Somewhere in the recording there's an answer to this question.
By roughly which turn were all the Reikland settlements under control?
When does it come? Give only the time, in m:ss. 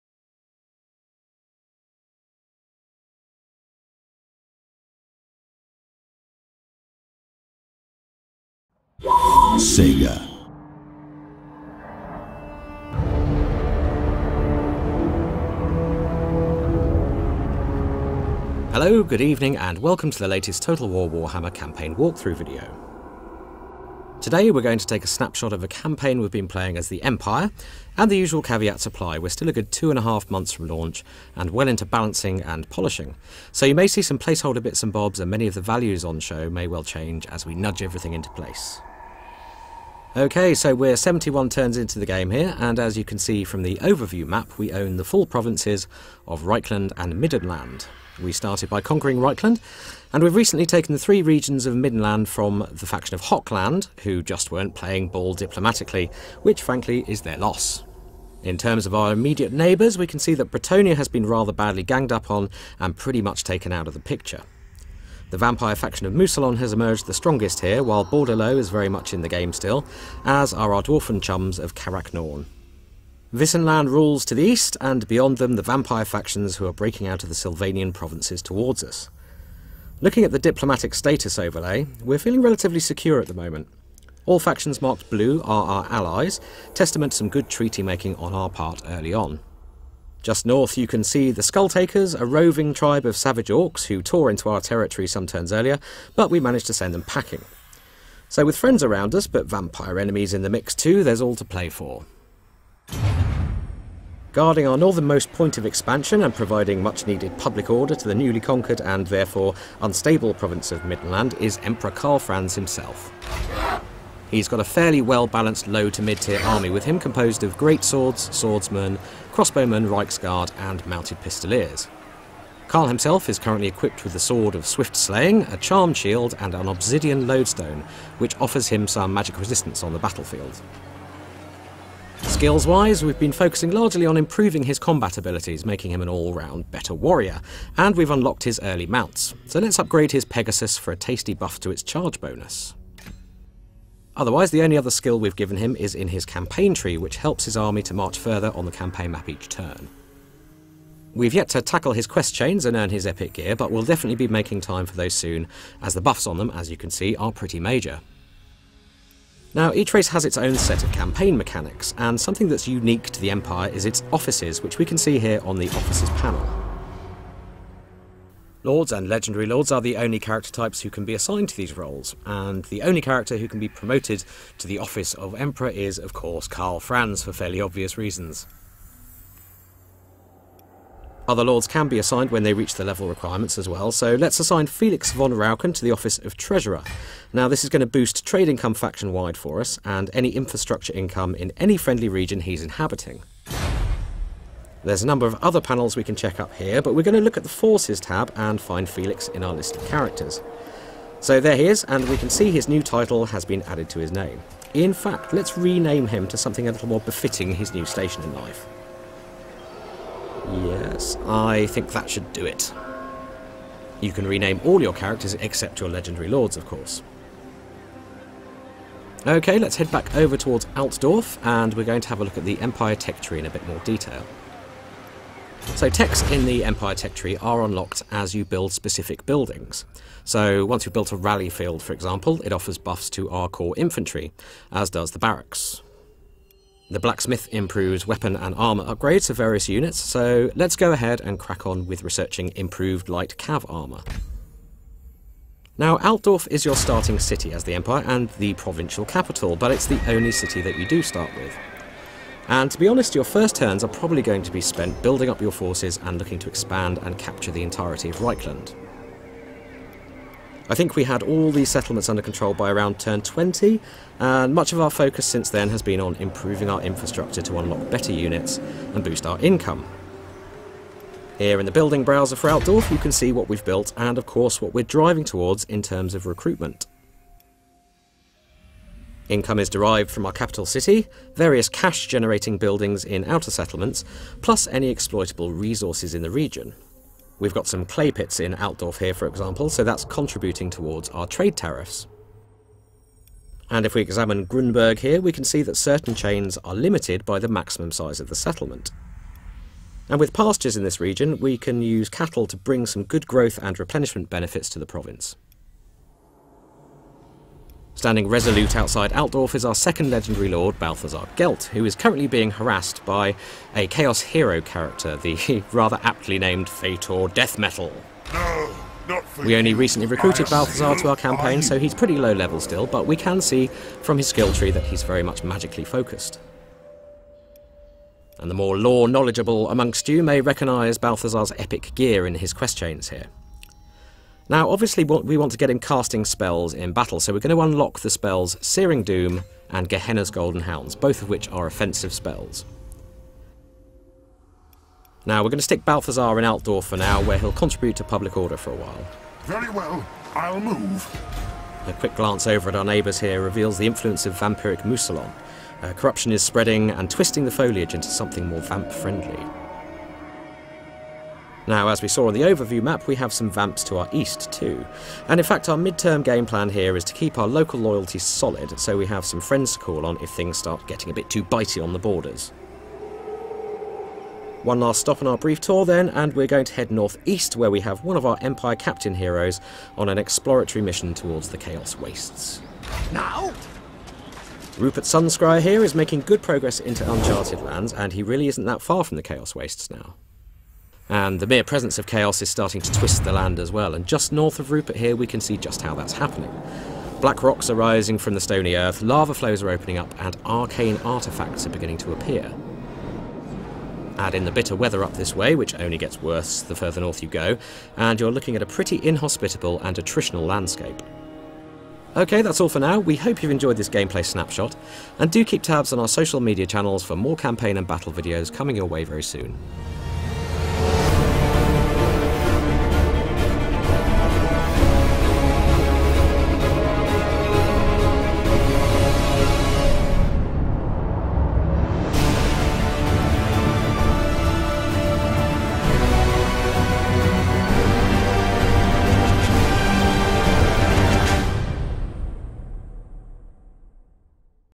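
4:22.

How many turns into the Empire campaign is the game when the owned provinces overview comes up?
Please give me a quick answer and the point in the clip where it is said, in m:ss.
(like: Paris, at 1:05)
71, at 0:40.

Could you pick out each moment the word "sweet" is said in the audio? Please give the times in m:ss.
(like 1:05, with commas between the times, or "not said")
not said.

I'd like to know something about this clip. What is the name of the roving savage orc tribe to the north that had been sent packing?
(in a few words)
Skulltakers.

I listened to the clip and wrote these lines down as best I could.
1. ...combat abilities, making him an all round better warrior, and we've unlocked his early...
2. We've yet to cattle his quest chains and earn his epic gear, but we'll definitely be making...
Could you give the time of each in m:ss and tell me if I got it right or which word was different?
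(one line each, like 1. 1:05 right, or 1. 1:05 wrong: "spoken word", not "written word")
1. 2:14 right
2. 2:31 wrong: "tackle", not "cattle".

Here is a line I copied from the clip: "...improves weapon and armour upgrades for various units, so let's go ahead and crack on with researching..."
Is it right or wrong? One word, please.
right.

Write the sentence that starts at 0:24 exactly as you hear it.
Today we're going to take a snapshot of a campaign we've been playing as the Empire, and the usual caveats apply.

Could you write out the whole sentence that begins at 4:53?
And if we examine Grunburg here, we can see that certain chains are limited by the maximum size of the settlement.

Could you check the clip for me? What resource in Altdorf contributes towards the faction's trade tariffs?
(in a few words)
Clay pits.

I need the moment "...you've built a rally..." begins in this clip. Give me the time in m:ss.
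3:50.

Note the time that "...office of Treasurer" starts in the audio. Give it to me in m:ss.
3:05.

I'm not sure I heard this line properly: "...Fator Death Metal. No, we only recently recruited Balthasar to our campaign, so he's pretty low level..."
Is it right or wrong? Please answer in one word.
right.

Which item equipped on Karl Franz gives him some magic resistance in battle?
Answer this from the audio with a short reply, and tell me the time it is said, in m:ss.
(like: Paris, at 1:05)
Obsidian Lodestone, at 2:06.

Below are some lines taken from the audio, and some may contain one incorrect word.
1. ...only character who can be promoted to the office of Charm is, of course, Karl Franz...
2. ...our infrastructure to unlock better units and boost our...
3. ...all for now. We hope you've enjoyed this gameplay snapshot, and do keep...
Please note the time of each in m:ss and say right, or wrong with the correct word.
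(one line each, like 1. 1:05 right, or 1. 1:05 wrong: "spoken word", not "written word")
1. 2:52 wrong: "Emperor", not "Charm"
2. 4:26 right
3. 6:52 right.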